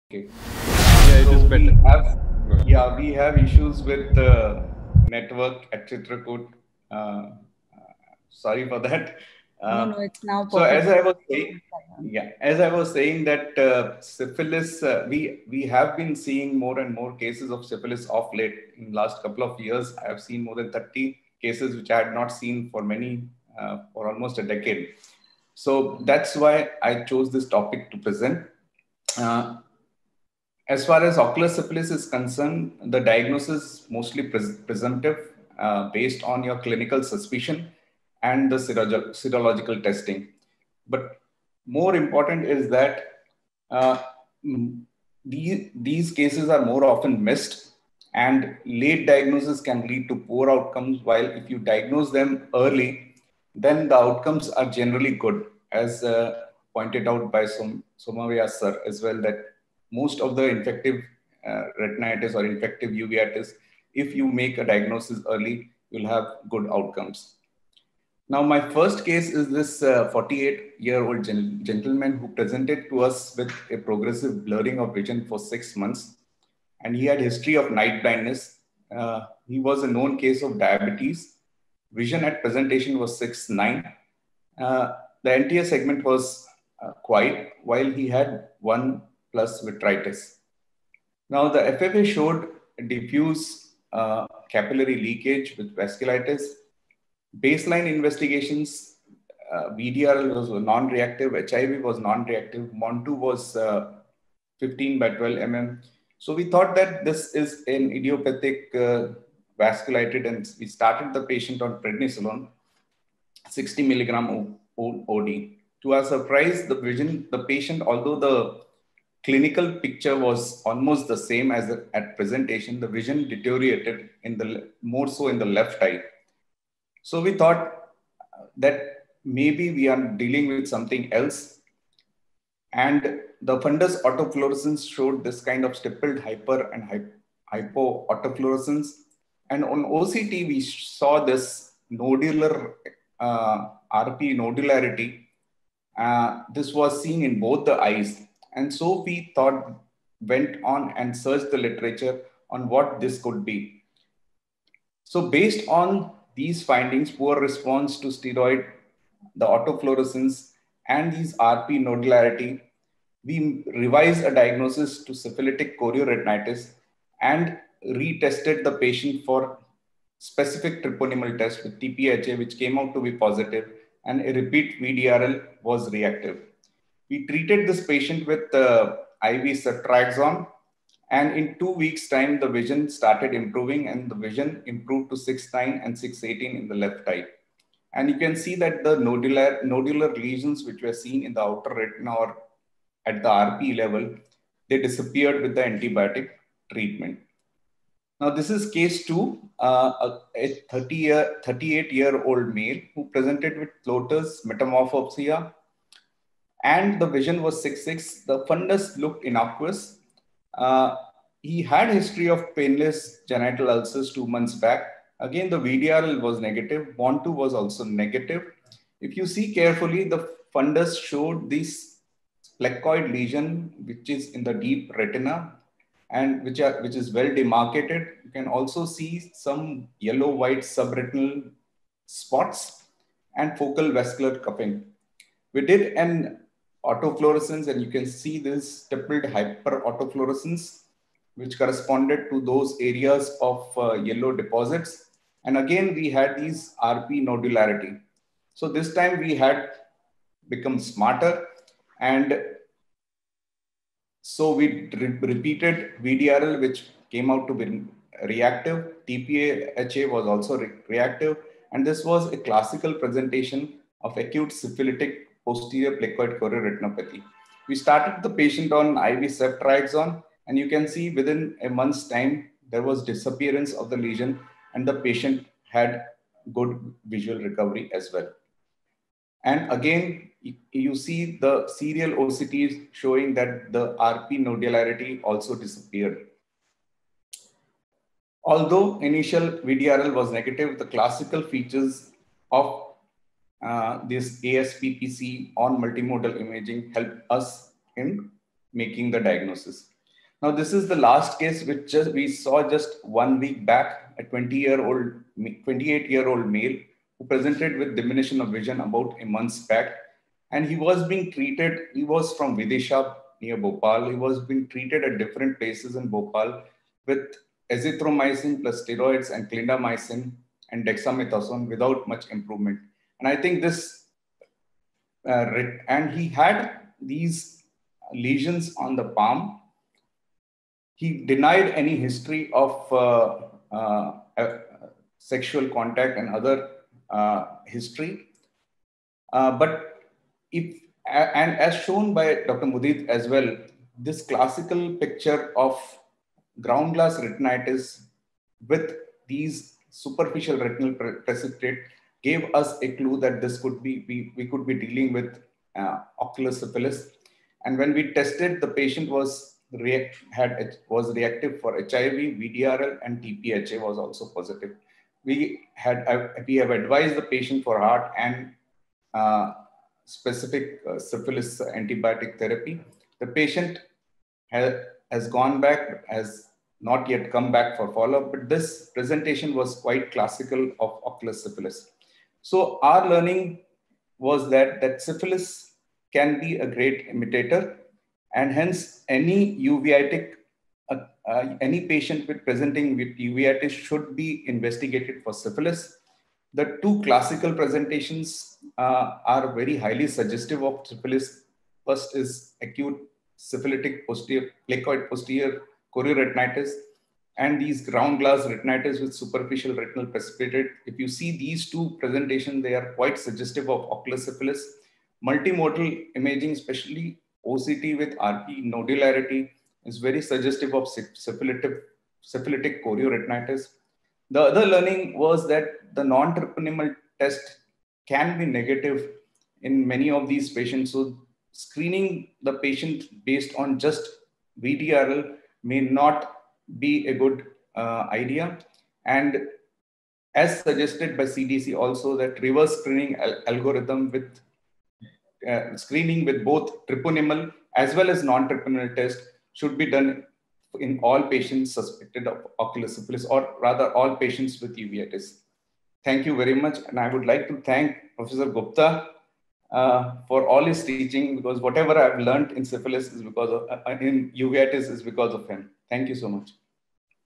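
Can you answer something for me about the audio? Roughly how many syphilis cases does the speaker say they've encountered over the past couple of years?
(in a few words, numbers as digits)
more than 30.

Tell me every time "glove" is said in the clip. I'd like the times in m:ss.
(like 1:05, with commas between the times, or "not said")
not said.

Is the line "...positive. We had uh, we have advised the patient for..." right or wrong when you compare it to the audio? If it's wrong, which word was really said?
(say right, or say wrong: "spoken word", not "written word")
right.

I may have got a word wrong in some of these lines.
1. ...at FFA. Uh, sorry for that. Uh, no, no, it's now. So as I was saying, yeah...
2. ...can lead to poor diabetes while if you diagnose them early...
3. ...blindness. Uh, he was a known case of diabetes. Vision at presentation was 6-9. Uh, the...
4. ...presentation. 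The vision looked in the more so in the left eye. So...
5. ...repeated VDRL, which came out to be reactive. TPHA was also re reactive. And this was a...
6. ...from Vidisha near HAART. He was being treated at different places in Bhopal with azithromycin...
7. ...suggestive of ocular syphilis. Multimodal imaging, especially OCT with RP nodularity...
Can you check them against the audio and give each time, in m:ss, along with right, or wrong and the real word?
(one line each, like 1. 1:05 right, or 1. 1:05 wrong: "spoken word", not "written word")
1. 0:05 wrong: "Chitrakoot", not "FFA"
2. 0:49 wrong: "outcomes", not "diabetes"
3. 1:18 right
4. 2:02 wrong: "deteriorated", not "looked"
5. 4:15 right
6. 5:12 wrong: "Bhopal", not "HAART"
7. 6:53 right.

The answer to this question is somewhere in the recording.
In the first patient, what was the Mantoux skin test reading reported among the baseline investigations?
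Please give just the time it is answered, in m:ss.
1:44.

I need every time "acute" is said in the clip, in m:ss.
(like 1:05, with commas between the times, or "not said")
4:24, 6:42.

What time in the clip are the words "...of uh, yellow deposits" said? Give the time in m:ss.
4:03.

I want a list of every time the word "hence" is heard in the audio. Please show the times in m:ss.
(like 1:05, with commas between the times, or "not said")
6:28.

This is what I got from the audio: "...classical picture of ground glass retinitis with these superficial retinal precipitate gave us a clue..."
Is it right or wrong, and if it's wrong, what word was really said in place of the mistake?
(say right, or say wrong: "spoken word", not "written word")
right.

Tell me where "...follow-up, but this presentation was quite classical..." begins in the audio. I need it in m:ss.
6:17.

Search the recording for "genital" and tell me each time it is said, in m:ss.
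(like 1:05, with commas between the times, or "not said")
3:33.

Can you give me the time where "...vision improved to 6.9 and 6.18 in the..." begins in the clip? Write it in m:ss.
3:04.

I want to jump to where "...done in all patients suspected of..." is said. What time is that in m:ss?
7:29.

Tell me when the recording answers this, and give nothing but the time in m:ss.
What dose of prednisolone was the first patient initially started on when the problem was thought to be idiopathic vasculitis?
1:53.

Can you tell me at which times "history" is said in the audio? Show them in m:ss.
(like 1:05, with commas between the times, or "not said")
1:17, 3:31, 5:31, 5:37.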